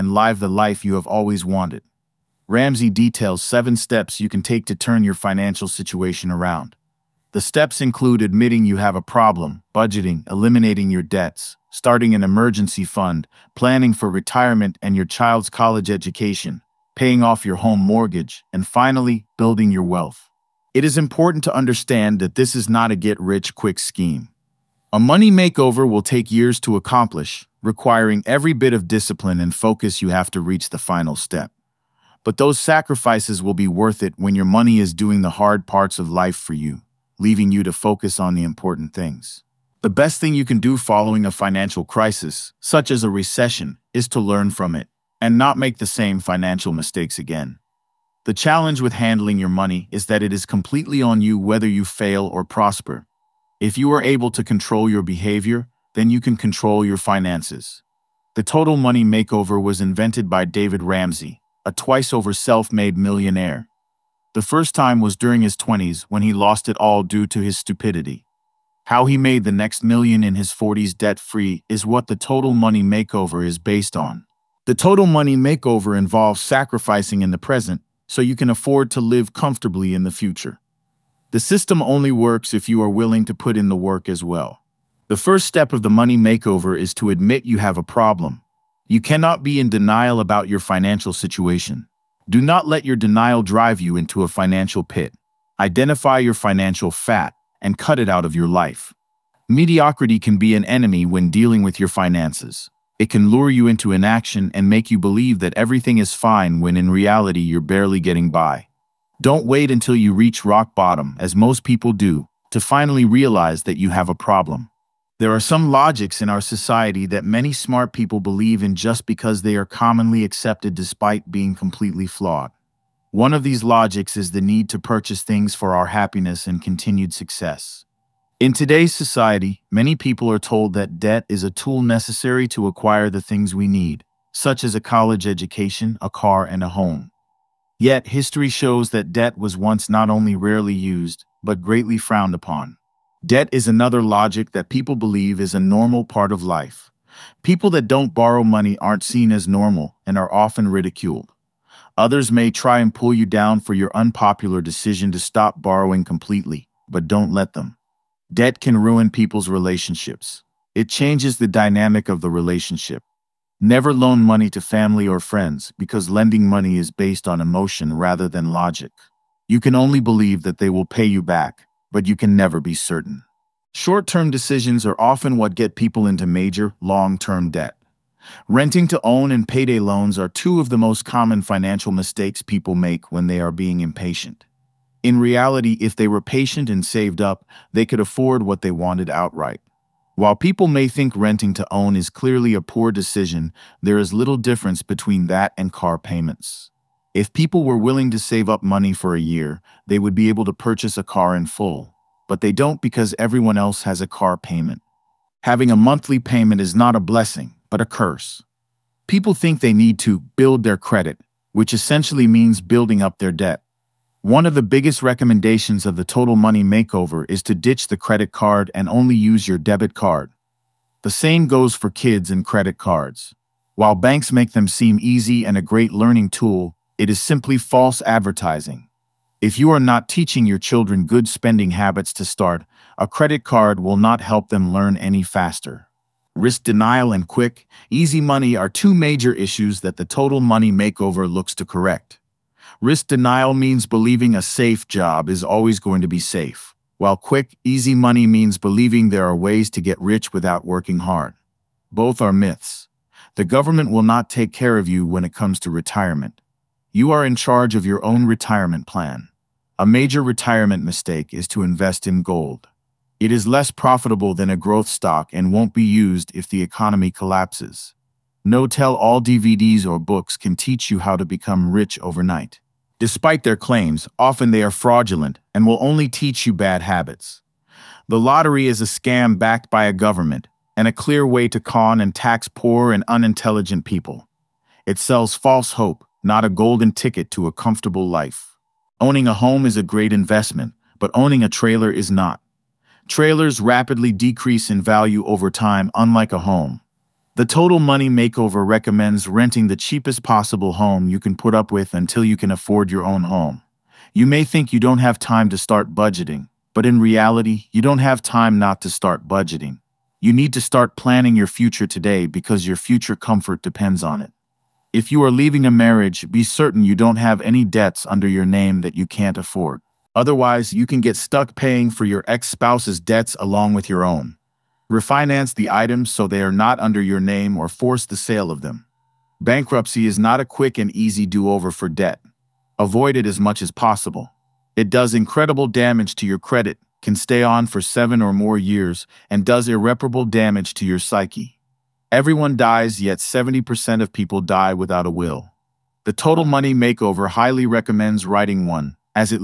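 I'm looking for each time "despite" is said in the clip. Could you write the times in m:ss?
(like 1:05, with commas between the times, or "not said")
2:00, 4:32.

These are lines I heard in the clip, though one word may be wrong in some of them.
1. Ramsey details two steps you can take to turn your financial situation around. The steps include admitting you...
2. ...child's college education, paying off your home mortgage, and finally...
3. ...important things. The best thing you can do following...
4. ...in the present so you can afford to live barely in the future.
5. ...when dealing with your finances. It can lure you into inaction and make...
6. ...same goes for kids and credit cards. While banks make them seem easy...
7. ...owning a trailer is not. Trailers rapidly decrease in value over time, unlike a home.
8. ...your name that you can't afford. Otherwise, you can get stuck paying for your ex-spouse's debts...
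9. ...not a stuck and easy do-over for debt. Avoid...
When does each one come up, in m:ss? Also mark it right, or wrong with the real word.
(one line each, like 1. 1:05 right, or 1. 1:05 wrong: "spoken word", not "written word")
1. 0:02 wrong: "seven", not "two"
2. 0:15 right
3. 0:38 right
4. 1:17 wrong: "comfortably", not "barely"
5. 1:41 right
6. 3:41 right
7. 4:51 right
8. 5:18 right
9. 5:30 wrong: "quick", not "stuck".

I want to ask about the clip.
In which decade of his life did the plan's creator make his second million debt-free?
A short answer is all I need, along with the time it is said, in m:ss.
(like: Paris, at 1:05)
40s, at 1:10.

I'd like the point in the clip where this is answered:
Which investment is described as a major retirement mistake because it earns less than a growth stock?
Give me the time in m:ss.
4:22.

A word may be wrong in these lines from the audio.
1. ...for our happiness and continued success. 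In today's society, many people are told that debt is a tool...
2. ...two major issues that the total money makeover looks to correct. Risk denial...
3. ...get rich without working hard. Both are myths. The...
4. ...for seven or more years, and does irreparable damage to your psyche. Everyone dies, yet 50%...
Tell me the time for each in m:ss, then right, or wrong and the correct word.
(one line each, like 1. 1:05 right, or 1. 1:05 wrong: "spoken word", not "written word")
1. 2:05 right
2. 3:58 right
3. 4:09 right
4. 5:37 wrong: "70", not "50".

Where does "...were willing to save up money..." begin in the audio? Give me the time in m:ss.
3:17.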